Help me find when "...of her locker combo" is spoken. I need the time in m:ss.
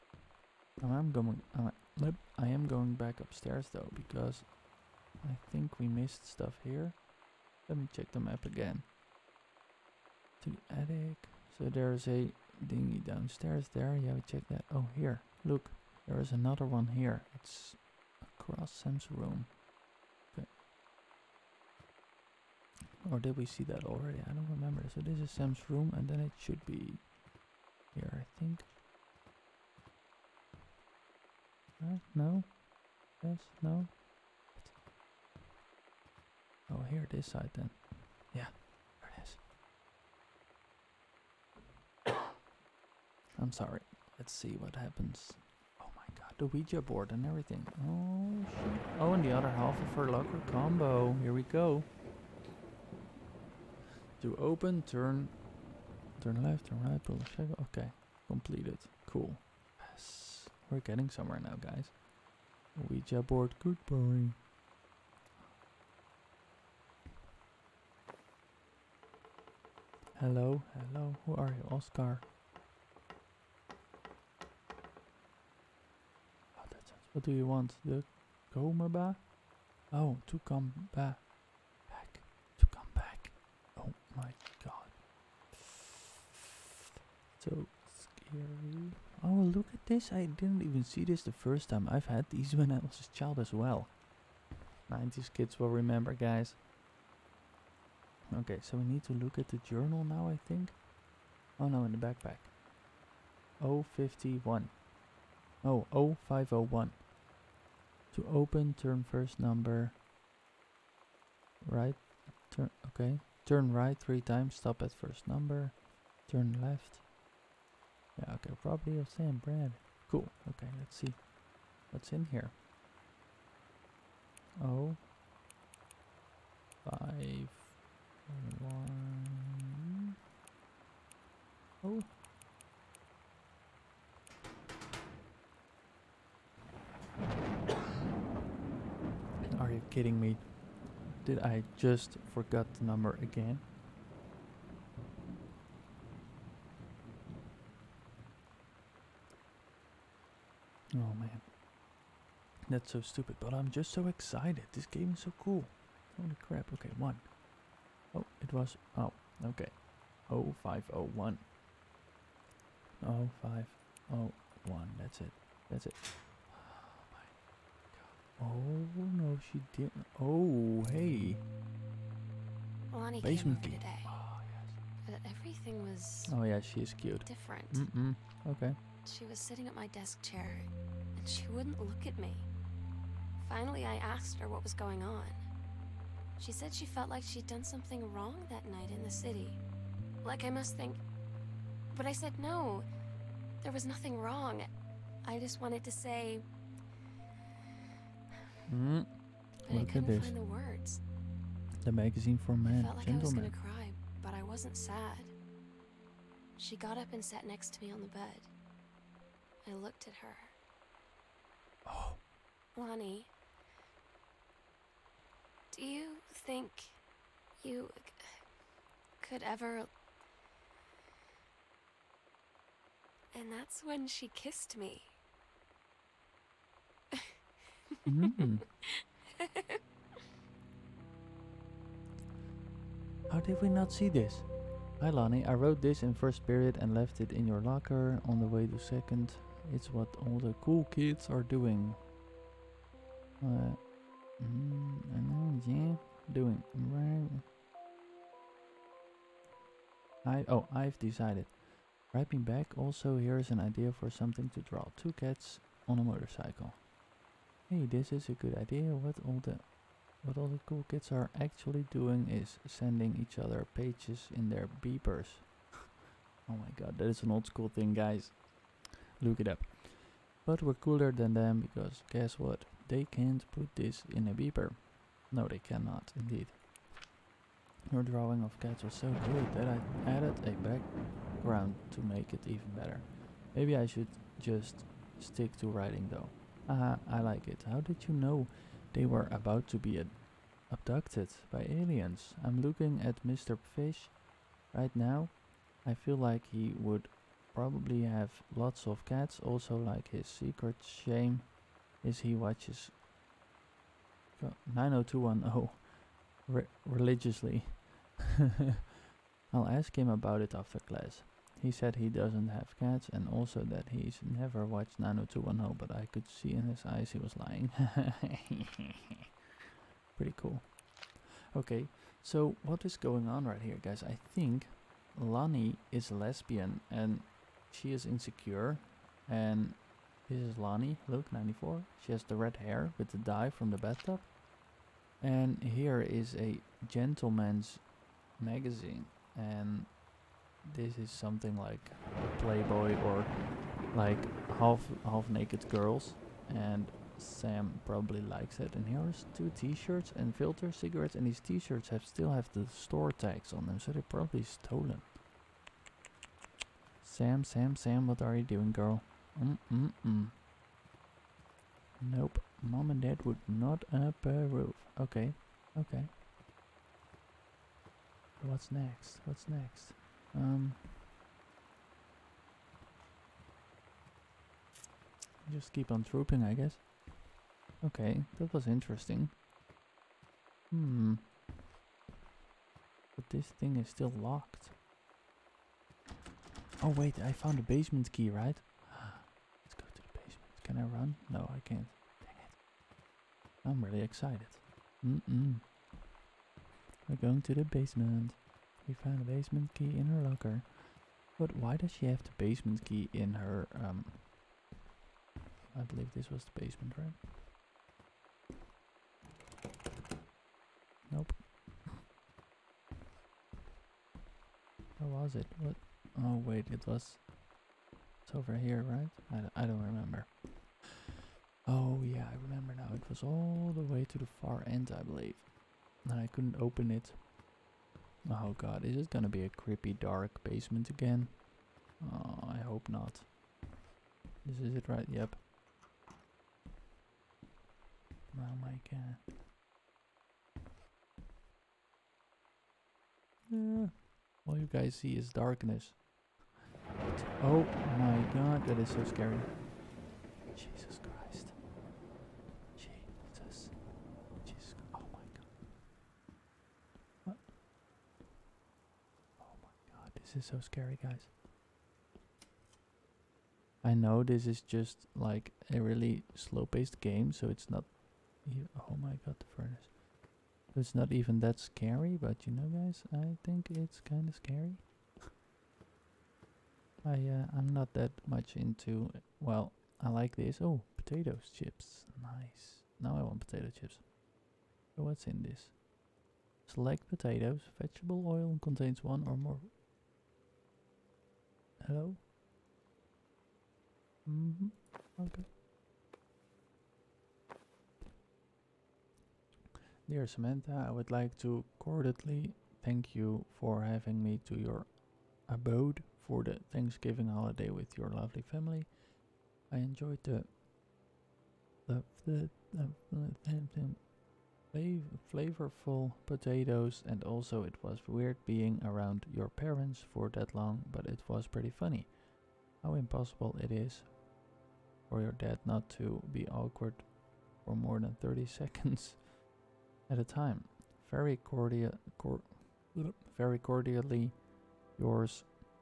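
0:49.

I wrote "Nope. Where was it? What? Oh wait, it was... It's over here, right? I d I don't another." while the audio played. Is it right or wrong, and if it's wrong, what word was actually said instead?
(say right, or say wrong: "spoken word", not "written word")
wrong: "remember", not "another".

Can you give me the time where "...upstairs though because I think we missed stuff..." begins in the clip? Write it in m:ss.
0:03.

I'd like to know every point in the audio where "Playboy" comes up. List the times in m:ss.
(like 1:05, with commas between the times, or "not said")
5:42.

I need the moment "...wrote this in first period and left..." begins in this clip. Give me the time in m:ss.
3:55.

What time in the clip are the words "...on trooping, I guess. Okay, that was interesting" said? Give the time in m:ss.
6:15.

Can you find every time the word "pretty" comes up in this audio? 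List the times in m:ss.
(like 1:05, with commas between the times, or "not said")
5:20, 8:41.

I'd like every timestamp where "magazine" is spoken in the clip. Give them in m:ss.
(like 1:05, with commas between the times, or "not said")
3:21, 5:38.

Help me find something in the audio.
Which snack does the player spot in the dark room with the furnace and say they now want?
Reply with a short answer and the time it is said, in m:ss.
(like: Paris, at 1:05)
potato chips, at 8:03.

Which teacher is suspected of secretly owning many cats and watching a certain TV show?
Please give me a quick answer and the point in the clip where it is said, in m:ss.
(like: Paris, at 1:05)
Mr. Fish, at 4:53.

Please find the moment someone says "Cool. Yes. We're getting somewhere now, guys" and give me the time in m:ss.
0:59.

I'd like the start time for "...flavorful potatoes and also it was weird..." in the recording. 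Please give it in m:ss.
8:35.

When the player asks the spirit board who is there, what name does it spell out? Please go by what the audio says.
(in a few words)
Oscar.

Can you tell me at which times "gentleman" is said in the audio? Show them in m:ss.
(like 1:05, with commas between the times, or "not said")
3:23, 5:36.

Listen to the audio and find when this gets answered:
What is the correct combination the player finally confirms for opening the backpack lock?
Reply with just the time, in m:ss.
2:40.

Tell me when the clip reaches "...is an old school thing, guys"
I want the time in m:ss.
4:27.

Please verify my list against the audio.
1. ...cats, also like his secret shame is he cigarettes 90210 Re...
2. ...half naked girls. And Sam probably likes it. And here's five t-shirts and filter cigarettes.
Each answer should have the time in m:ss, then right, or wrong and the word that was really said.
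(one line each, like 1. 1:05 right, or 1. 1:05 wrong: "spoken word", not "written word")
1. 4:59 wrong: "watches", not "cigarettes"
2. 5:45 wrong: "two", not "five".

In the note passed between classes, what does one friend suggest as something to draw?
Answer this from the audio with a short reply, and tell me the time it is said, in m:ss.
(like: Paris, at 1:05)
two cats on a motorcycle, at 4:14.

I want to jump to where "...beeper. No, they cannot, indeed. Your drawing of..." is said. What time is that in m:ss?
4:34.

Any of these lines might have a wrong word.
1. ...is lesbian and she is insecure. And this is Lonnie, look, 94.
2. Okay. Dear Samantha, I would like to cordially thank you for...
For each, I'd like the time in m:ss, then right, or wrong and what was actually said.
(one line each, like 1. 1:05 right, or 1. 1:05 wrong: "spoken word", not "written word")
1. 5:25 right
2. 8:15 right.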